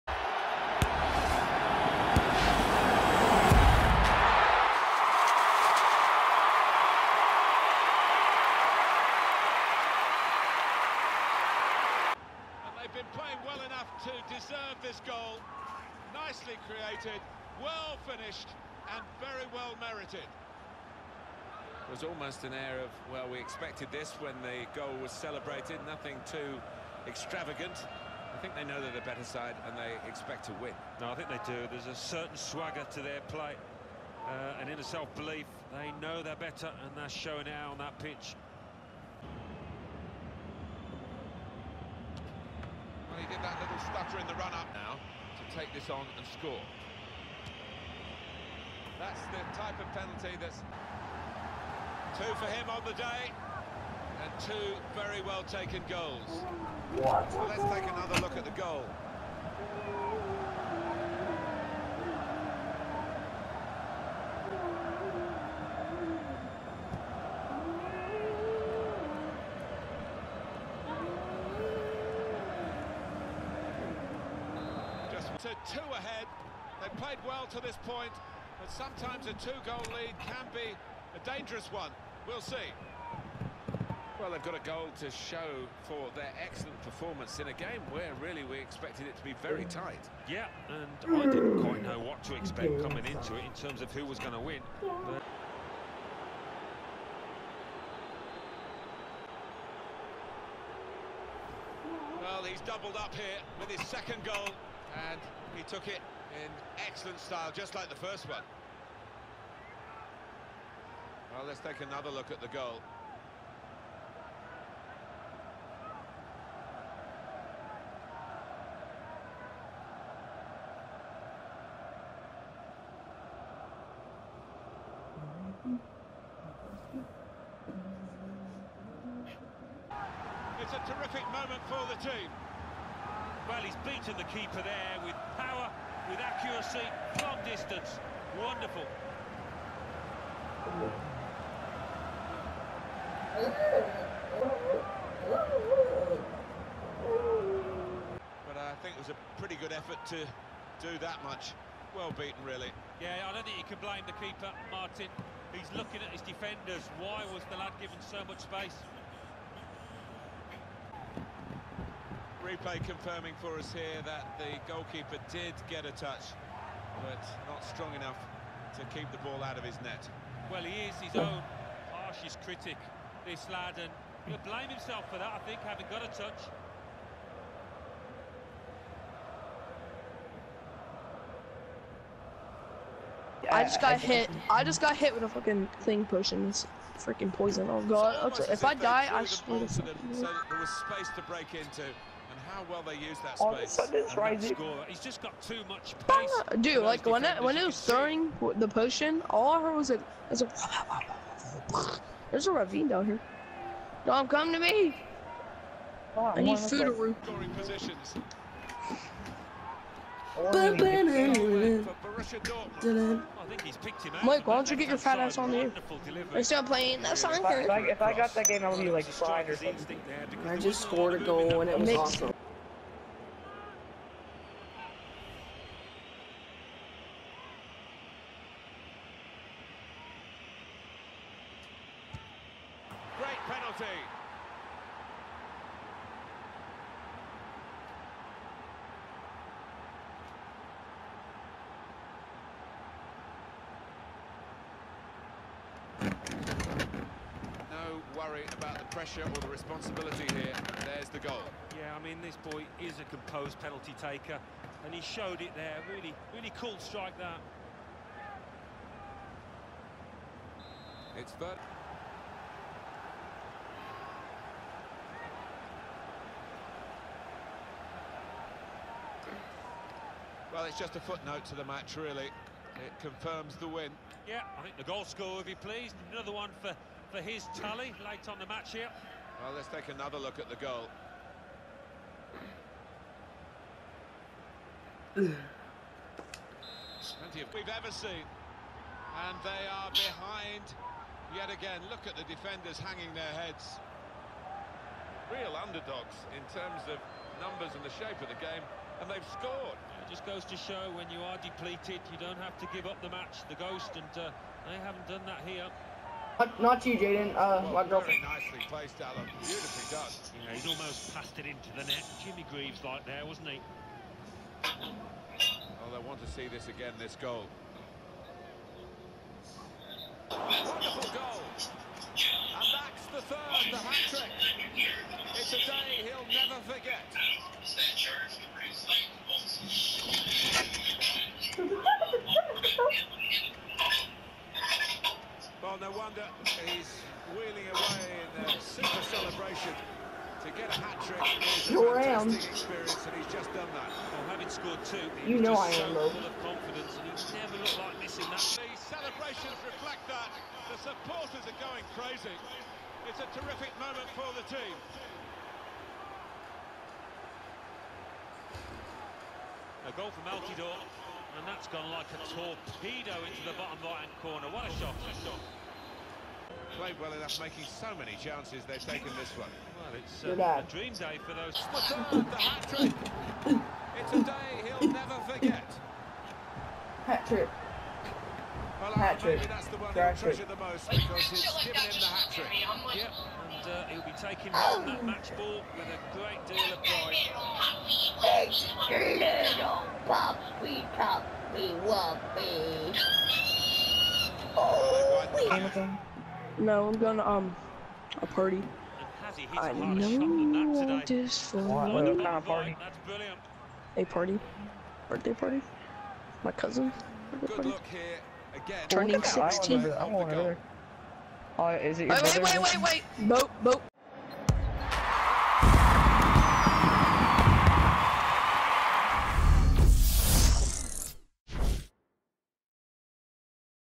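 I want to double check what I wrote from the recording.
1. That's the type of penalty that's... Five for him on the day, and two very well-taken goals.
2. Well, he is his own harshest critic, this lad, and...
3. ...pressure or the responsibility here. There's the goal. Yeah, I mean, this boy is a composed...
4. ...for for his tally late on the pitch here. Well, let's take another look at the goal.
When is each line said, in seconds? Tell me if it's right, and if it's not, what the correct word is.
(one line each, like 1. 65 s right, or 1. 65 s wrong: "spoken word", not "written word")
1. 48 s wrong: "Two", not "Five"
2. 170 s right
3. 248 s right
4. 276 s wrong: "match", not "pitch".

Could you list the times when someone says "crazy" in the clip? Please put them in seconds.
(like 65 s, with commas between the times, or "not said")
351 s.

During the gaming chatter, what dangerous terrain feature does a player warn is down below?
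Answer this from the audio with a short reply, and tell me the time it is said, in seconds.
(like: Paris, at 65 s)
ravine, at 202 s.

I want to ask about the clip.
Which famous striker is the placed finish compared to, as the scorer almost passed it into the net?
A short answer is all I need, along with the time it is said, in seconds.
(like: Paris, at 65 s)
Jimmy Greaves, at 312 s.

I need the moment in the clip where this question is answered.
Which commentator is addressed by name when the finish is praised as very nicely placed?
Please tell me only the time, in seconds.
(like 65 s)
308 s.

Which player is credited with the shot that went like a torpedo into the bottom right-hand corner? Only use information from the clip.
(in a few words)
Altidore.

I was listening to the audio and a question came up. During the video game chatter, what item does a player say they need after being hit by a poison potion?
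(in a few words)
food.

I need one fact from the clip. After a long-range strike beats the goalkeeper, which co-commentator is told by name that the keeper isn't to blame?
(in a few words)
Martin.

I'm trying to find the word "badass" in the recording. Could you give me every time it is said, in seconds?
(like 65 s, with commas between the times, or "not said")
not said.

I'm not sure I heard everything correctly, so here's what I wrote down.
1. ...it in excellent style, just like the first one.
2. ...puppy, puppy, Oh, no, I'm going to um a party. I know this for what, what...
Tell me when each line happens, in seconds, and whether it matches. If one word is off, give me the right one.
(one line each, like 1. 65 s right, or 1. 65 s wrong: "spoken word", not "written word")
1. 105 s right
2. 390 s right.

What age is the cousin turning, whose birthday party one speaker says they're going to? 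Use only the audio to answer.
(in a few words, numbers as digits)
16.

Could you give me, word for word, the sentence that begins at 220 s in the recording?
I just scored a goal and it was awesome.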